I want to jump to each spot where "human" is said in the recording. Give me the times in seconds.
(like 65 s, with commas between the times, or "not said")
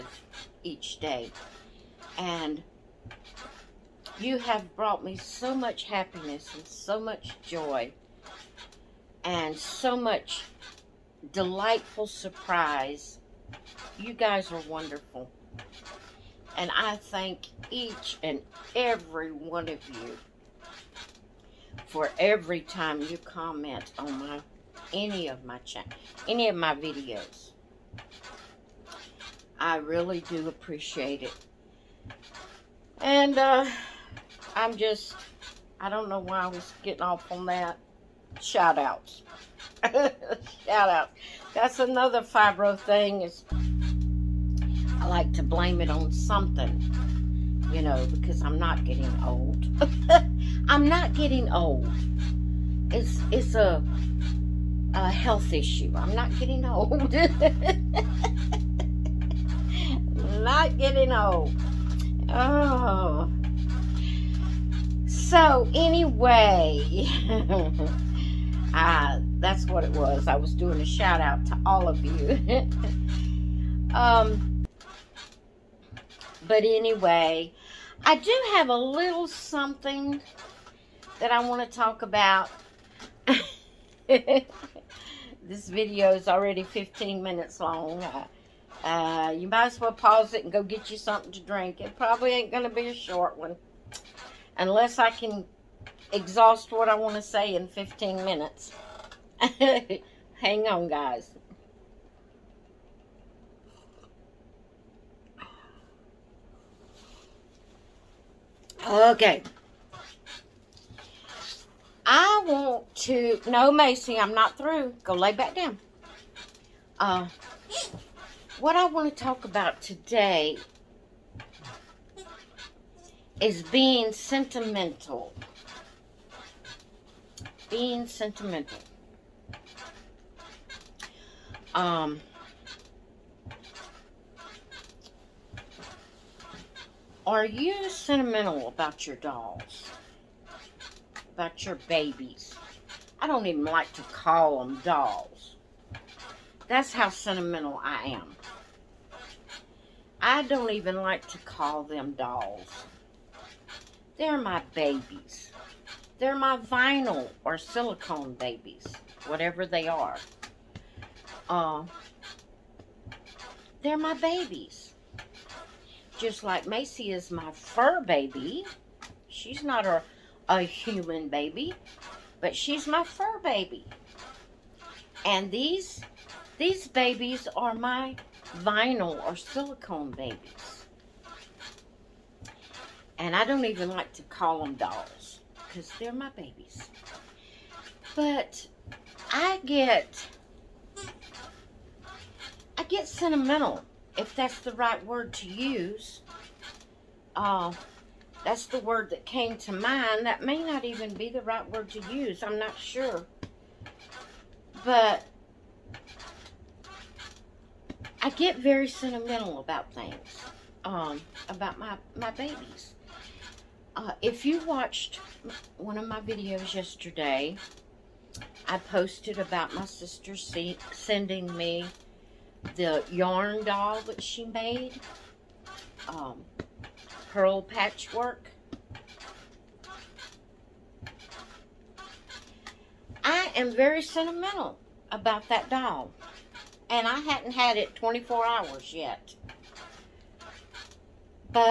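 170 s.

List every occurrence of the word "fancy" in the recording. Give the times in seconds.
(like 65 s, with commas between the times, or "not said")
not said.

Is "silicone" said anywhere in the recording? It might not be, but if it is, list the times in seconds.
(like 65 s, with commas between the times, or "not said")
157 s, 179 s.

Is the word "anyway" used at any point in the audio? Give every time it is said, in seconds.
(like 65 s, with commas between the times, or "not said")
65 s, 76 s.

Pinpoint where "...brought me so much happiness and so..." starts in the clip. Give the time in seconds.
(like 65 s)
4 s.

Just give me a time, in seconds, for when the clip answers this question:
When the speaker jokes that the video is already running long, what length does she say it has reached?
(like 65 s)
86 s.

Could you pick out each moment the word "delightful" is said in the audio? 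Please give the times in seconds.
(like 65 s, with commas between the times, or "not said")
11 s.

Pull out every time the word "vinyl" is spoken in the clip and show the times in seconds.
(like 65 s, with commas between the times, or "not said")
156 s, 178 s.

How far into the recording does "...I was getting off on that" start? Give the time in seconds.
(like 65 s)
36 s.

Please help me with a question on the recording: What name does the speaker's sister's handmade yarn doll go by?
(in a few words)
Pearl Patchwork.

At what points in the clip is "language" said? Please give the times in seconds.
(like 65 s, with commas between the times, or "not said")
not said.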